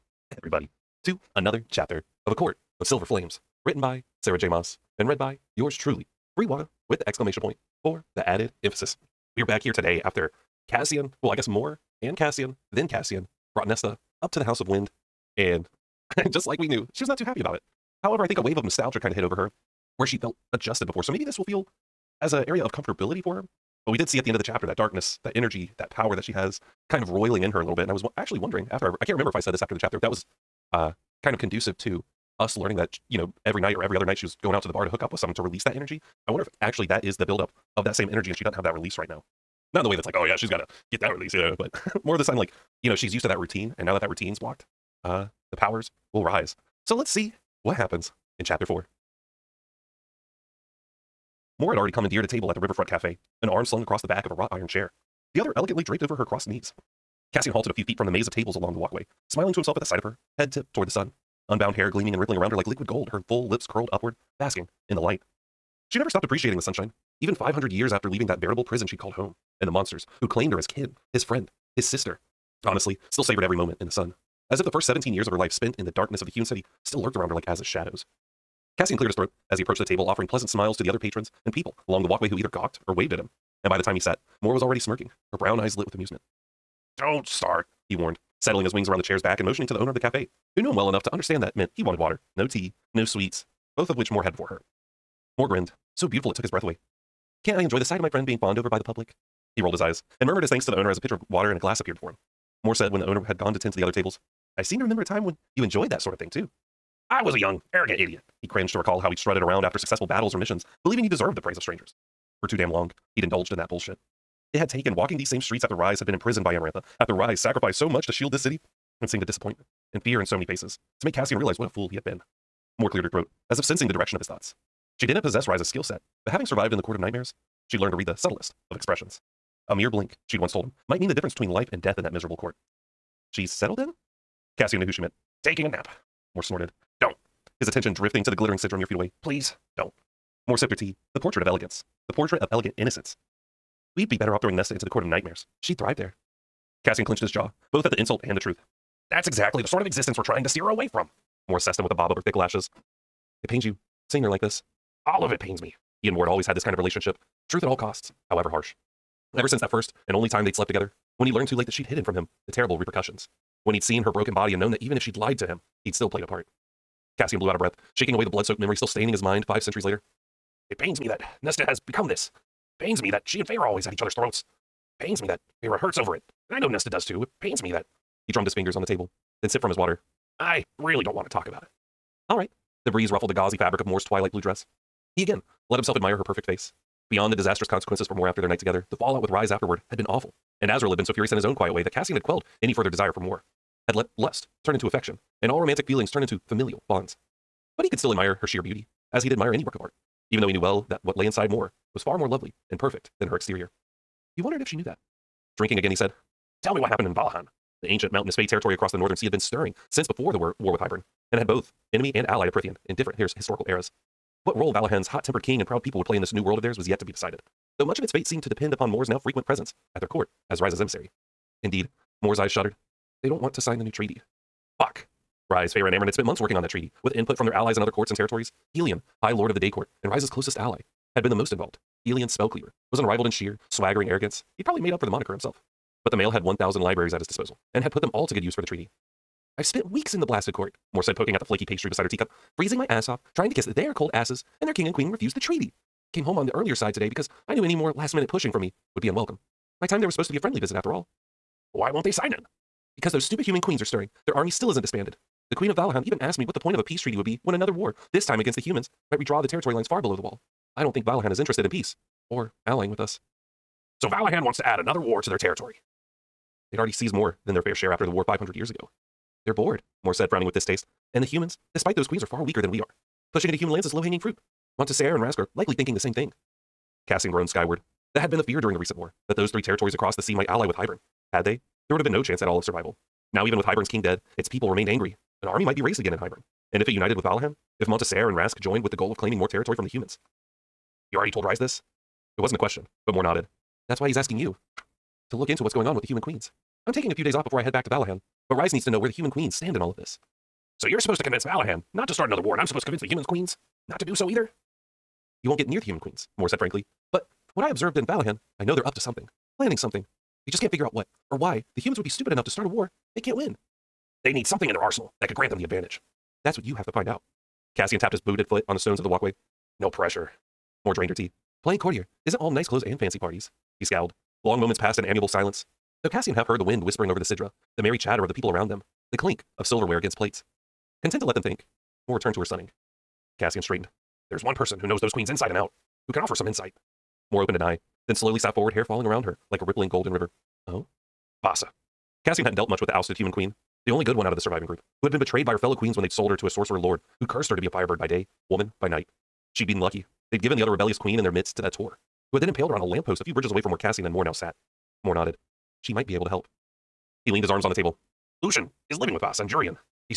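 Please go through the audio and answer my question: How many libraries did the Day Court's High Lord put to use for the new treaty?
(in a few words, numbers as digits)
1,000.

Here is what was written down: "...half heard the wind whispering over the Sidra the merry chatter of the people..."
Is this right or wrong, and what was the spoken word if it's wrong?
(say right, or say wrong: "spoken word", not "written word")
right.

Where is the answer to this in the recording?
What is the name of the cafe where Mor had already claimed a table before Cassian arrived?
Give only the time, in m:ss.
0:52.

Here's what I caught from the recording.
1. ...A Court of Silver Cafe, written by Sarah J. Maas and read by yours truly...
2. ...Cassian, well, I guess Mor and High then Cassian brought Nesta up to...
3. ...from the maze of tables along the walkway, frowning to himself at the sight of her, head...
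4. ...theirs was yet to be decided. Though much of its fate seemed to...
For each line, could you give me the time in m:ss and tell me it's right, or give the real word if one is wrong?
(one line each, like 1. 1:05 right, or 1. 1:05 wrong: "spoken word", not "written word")
1. 0:02 wrong: "Flames", not "Cafe"
2. 0:10 wrong: "Cassian", not "High"
3. 0:57 wrong: "smiling", not "frowning"
4. 3:36 right.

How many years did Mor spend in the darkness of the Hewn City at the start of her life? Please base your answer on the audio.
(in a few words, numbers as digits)
17.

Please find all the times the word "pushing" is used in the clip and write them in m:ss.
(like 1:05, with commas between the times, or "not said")
4:08, 4:33.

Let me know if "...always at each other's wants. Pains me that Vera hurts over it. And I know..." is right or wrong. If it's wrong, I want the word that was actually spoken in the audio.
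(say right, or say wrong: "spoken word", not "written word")
wrong: "throats", not "wants".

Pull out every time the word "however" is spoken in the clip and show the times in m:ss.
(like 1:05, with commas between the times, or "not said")
0:18, 2:38.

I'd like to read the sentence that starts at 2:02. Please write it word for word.
Mor cleared her throat, as if sensing the direction of his thoughts.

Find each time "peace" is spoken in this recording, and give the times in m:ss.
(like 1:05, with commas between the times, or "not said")
4:16, 4:21.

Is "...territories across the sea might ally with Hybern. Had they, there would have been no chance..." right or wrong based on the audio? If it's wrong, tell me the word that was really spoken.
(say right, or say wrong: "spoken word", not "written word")
right.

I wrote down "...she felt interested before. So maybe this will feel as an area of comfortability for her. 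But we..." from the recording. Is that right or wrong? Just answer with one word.
wrong.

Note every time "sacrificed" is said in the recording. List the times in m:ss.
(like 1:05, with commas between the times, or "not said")
1:57.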